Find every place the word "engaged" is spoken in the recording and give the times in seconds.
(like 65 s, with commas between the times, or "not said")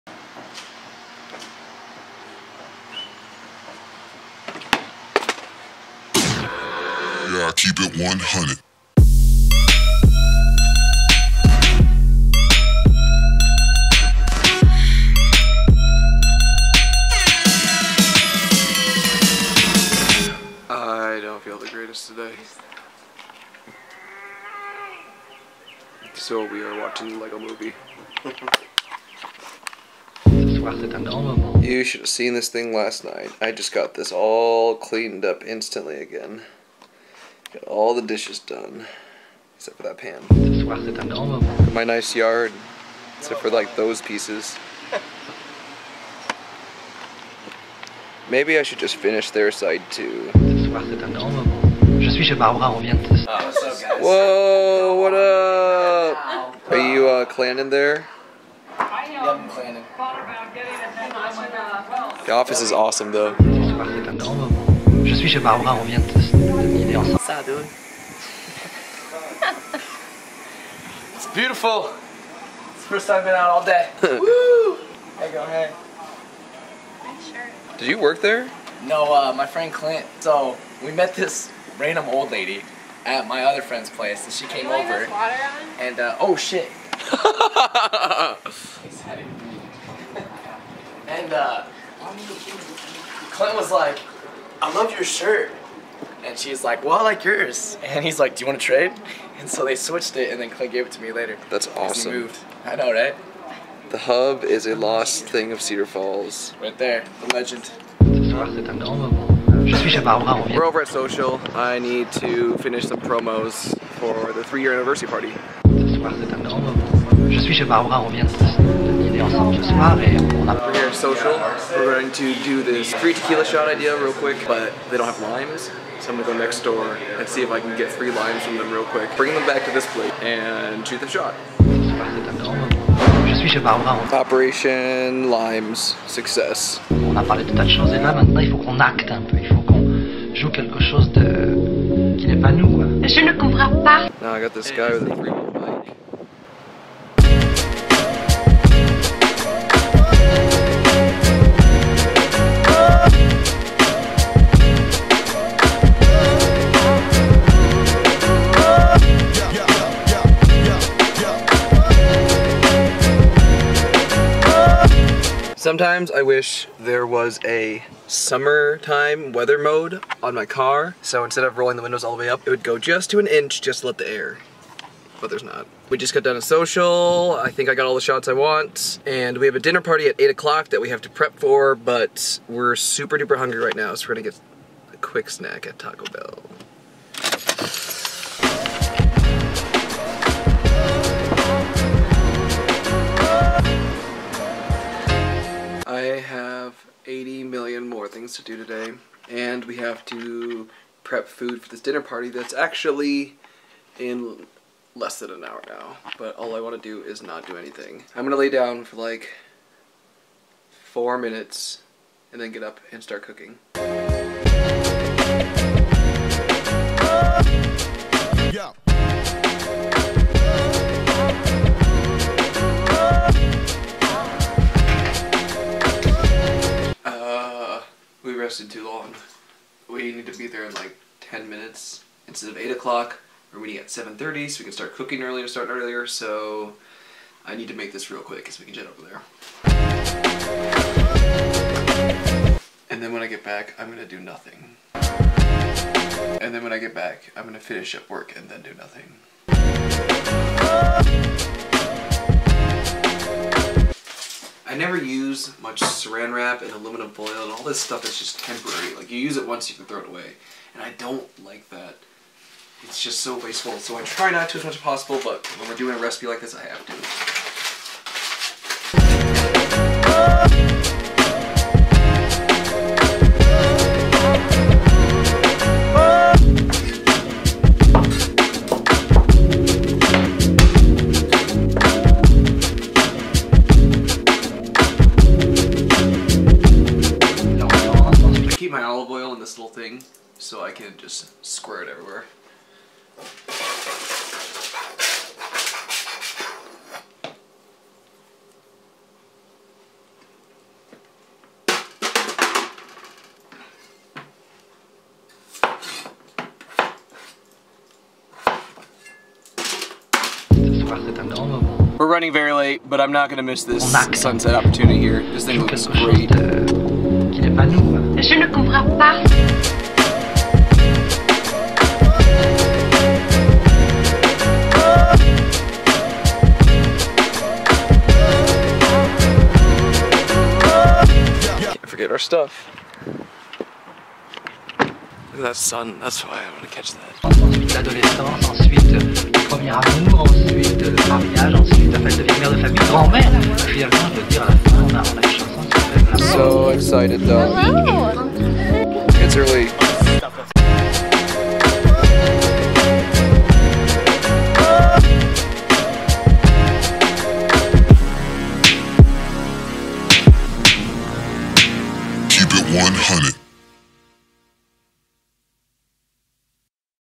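not said.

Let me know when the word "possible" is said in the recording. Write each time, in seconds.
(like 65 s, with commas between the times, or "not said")
264 s.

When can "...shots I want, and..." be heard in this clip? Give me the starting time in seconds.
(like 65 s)
178 s.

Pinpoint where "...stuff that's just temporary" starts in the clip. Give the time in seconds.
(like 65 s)
257 s.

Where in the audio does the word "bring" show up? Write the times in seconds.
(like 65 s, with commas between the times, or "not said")
129 s.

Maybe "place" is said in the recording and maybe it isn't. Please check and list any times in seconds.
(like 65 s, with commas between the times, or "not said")
83 s.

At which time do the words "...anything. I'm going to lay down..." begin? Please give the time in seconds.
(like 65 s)
207 s.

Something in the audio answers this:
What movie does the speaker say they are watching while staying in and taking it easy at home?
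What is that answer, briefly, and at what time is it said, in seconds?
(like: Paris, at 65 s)
Lego movie, at 27 s.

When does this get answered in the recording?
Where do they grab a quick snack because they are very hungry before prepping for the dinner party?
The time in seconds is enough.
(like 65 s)
185 s.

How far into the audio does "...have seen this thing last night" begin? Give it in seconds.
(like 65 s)
32 s.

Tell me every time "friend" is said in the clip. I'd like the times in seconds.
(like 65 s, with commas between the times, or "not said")
79 s, 83 s.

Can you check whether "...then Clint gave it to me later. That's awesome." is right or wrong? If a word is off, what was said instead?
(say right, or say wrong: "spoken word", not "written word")
right.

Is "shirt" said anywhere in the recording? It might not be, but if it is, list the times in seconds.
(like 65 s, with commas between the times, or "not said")
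77 s, 95 s.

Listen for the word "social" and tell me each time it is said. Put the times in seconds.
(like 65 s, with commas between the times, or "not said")
110 s, 120 s, 176 s.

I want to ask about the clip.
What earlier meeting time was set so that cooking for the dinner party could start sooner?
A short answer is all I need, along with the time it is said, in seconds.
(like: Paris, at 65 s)
7:30, at 233 s.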